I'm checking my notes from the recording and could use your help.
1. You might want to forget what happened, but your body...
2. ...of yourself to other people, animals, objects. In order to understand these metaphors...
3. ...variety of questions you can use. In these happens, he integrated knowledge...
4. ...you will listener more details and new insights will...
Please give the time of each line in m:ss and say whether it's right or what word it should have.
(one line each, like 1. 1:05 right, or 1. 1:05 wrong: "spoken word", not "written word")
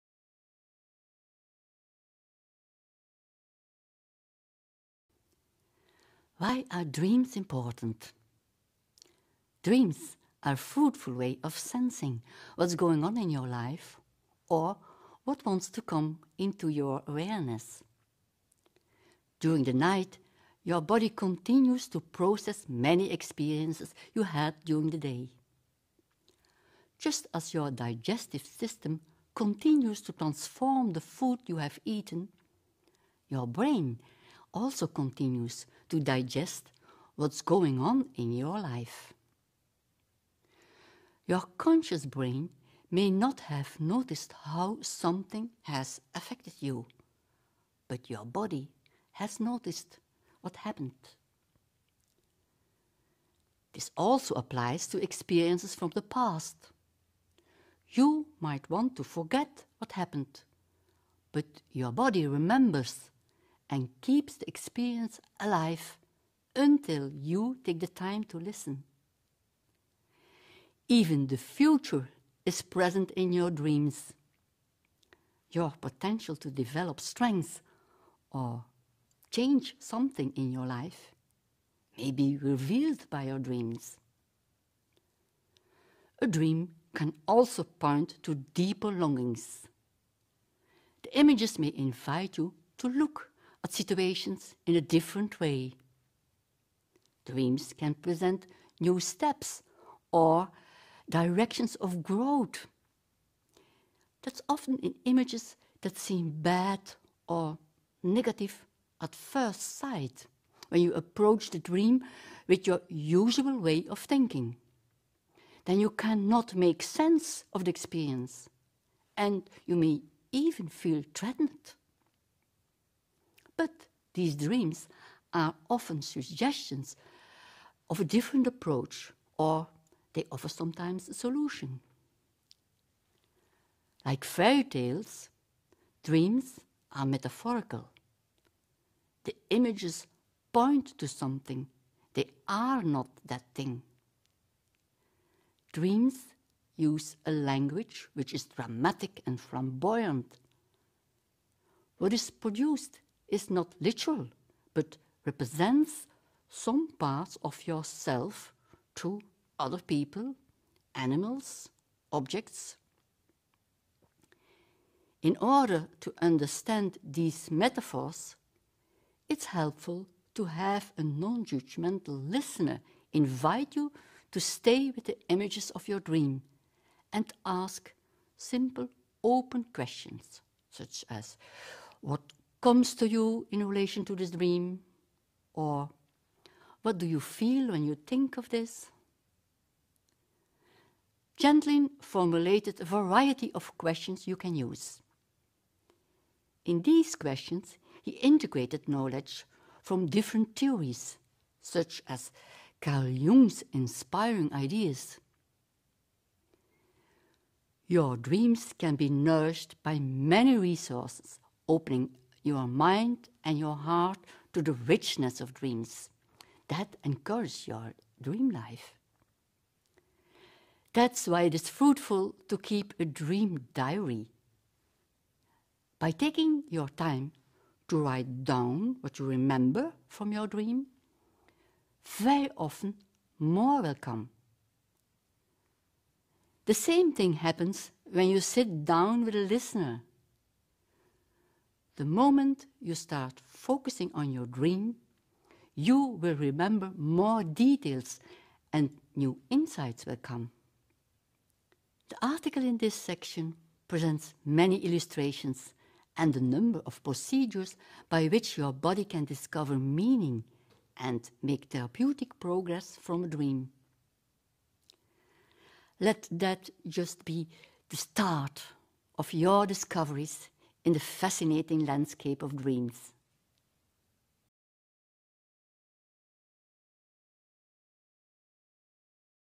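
1. 0:57 right
2. 2:37 right
3. 3:12 wrong: "questions", not "happens"
4. 4:05 wrong: "remember", not "listener".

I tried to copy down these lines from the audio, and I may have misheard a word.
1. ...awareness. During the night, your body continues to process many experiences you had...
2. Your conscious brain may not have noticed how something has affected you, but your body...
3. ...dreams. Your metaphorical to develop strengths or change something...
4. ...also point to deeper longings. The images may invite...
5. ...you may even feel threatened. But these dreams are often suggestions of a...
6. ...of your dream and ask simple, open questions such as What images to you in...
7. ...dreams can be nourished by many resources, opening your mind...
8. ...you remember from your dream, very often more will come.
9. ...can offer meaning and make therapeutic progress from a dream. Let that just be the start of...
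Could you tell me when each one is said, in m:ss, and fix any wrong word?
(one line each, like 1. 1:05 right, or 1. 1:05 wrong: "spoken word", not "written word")
1. 0:17 right
2. 0:41 right
3. 1:13 wrong: "potential", not "metaphorical"
4. 1:27 right
5. 1:59 right
6. 2:55 wrong: "comes", not "images"
7. 3:28 right
8. 3:49 right
9. 4:19 wrong: "discover", not "offer".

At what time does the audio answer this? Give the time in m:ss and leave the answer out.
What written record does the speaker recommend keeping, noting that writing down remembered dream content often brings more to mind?
3:43.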